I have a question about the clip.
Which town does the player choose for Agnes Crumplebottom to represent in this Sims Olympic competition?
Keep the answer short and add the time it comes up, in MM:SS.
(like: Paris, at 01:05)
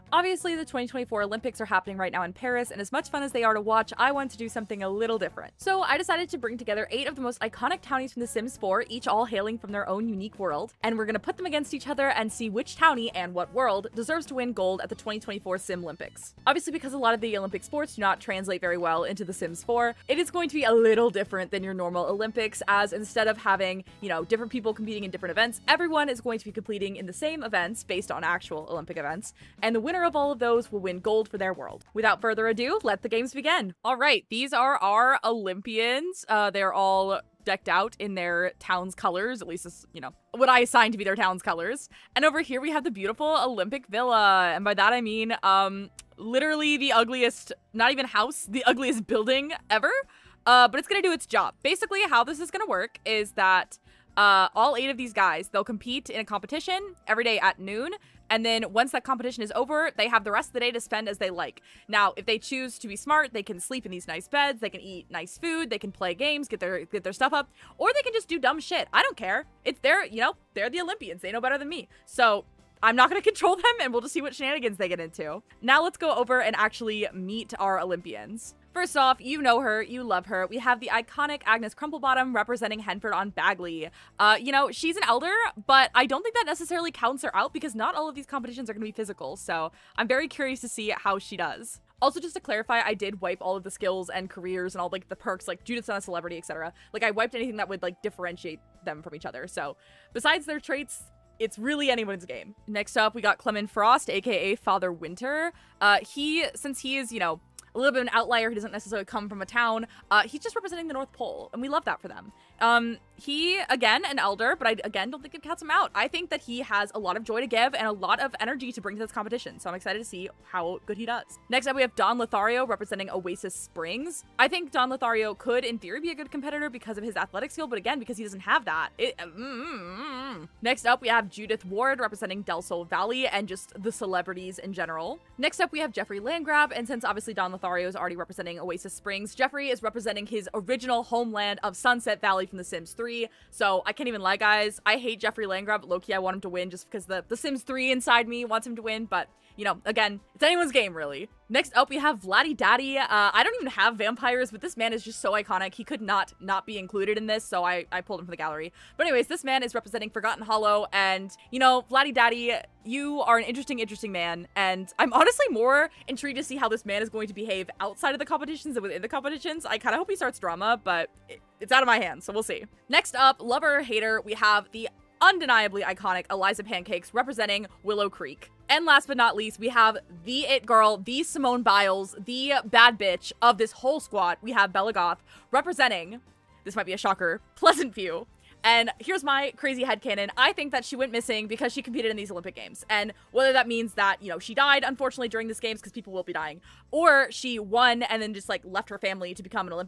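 Henford on Bagley, at 01:22.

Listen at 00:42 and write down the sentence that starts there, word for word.
And over here we have the beautiful Olympic Villa.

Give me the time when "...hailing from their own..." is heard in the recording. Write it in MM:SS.
00:09.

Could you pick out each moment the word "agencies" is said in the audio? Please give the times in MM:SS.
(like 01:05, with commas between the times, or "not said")
not said.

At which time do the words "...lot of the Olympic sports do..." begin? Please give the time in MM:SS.
00:16.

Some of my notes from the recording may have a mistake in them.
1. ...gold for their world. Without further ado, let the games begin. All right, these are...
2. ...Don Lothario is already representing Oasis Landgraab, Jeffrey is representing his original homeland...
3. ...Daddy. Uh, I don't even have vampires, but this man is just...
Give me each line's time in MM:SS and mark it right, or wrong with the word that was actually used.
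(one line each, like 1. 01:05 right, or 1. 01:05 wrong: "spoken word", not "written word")
1. 00:30 right
2. 02:17 wrong: "Springs", not "Landgraab"
3. 02:32 right.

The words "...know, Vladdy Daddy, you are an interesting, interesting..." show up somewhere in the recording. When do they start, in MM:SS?
02:41.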